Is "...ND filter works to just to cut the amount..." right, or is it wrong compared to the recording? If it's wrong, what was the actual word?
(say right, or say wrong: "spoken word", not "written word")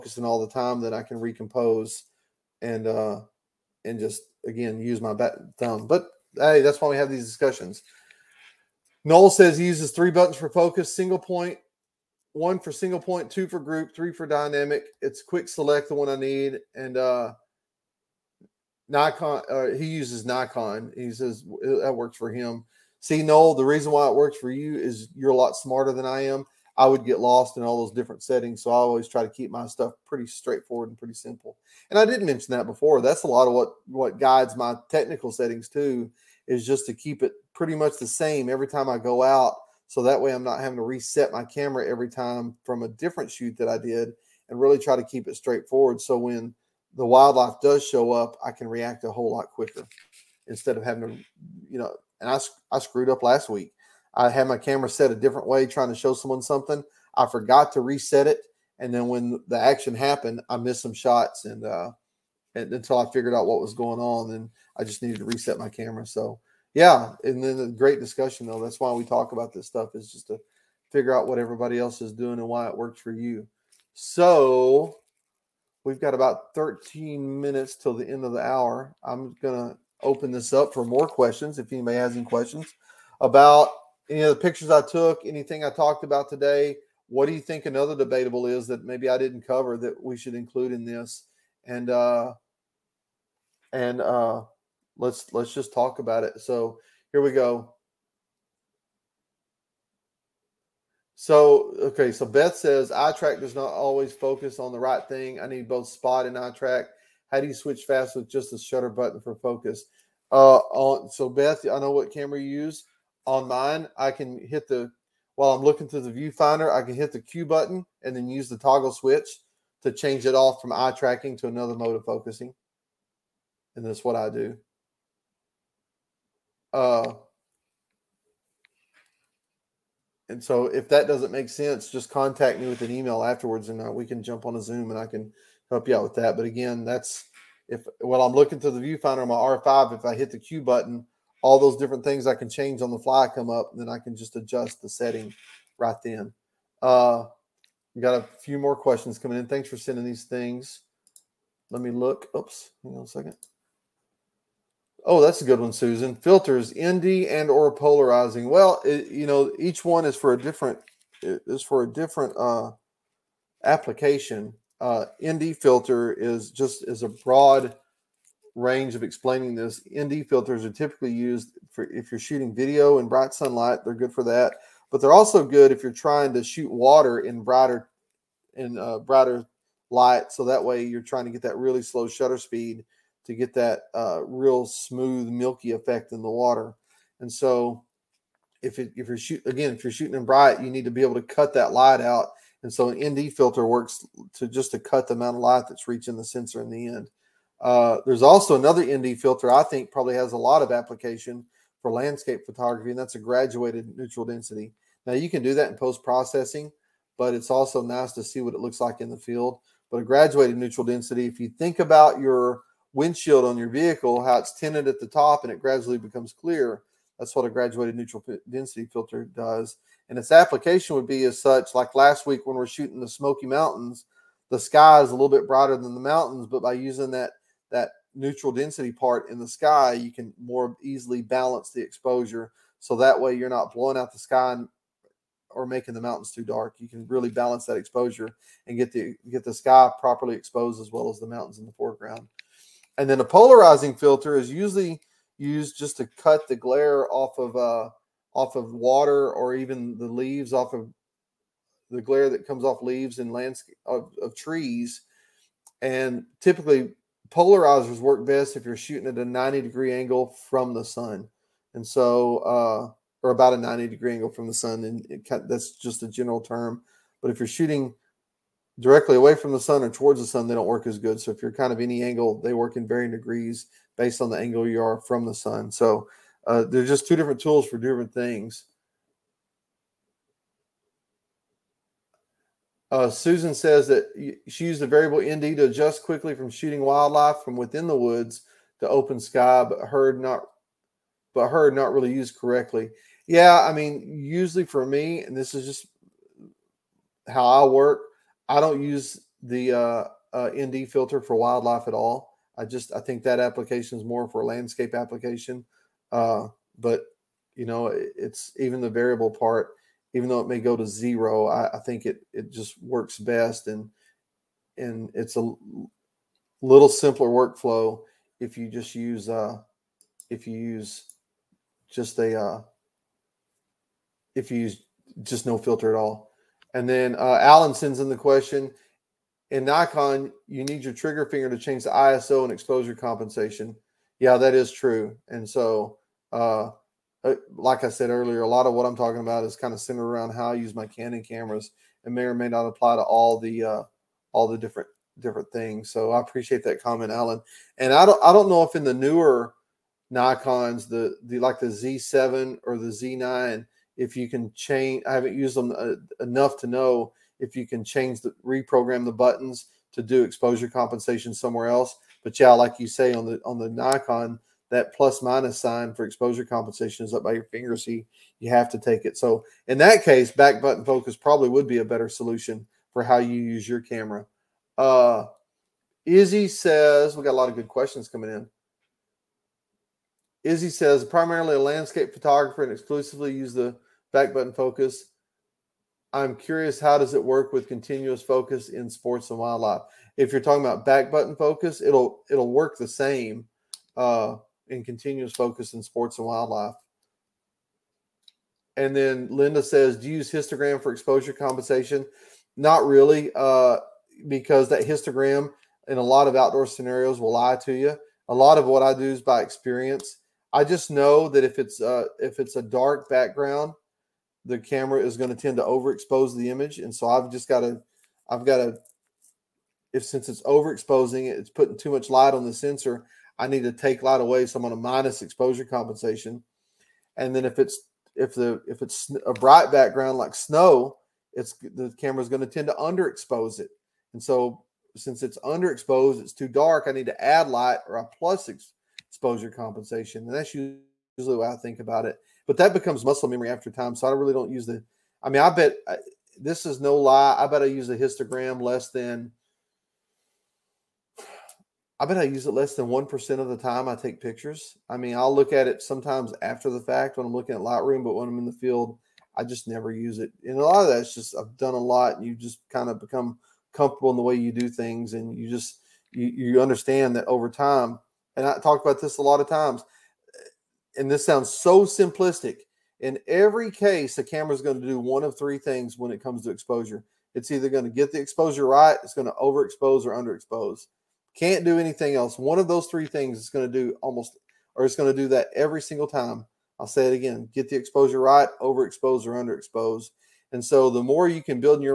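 right.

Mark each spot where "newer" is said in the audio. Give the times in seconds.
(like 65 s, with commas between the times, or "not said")
348 s.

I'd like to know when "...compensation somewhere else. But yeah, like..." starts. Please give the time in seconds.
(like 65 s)
360 s.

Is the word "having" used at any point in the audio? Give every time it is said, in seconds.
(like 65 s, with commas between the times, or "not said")
40 s, 50 s.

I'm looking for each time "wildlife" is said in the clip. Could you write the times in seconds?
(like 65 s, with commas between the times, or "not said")
47 s, 286 s, 301 s, 389 s, 396 s.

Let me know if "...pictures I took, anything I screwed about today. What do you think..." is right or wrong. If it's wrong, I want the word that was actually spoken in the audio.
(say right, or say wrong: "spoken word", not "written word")
wrong: "talked", not "screwed".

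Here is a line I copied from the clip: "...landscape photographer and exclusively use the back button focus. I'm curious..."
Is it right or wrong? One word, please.
right.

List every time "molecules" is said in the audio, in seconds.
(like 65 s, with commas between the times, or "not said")
not said.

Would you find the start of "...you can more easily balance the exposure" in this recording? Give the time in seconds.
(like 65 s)
229 s.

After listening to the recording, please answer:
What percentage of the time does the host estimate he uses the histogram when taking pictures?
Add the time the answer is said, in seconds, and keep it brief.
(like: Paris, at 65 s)
Less than 1%, at 452 s.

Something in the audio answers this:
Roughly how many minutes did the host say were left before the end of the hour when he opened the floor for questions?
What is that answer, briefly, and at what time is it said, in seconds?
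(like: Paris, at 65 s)
13, at 76 s.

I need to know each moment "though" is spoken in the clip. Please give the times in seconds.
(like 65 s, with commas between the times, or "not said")
68 s, 310 s.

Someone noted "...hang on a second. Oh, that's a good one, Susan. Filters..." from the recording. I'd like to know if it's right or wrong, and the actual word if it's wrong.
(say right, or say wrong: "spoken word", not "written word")
right.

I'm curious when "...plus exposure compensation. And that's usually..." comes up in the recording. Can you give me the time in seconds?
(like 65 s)
438 s.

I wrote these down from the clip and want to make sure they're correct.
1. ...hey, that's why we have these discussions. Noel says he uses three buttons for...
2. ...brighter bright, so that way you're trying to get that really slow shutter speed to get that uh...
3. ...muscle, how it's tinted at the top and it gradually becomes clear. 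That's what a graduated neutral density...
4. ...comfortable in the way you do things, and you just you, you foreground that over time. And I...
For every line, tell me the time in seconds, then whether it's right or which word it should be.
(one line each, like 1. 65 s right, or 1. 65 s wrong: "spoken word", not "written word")
1. 6 s right
2. 178 s wrong: "light", not "bright"
3. 213 s wrong: "vehicle", not "muscle"
4. 463 s wrong: "understand", not "foreground".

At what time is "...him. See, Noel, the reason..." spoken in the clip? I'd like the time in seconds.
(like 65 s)
22 s.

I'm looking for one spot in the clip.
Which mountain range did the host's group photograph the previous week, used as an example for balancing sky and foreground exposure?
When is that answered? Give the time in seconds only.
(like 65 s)
223 s.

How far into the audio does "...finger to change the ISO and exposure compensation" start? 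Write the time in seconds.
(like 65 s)
331 s.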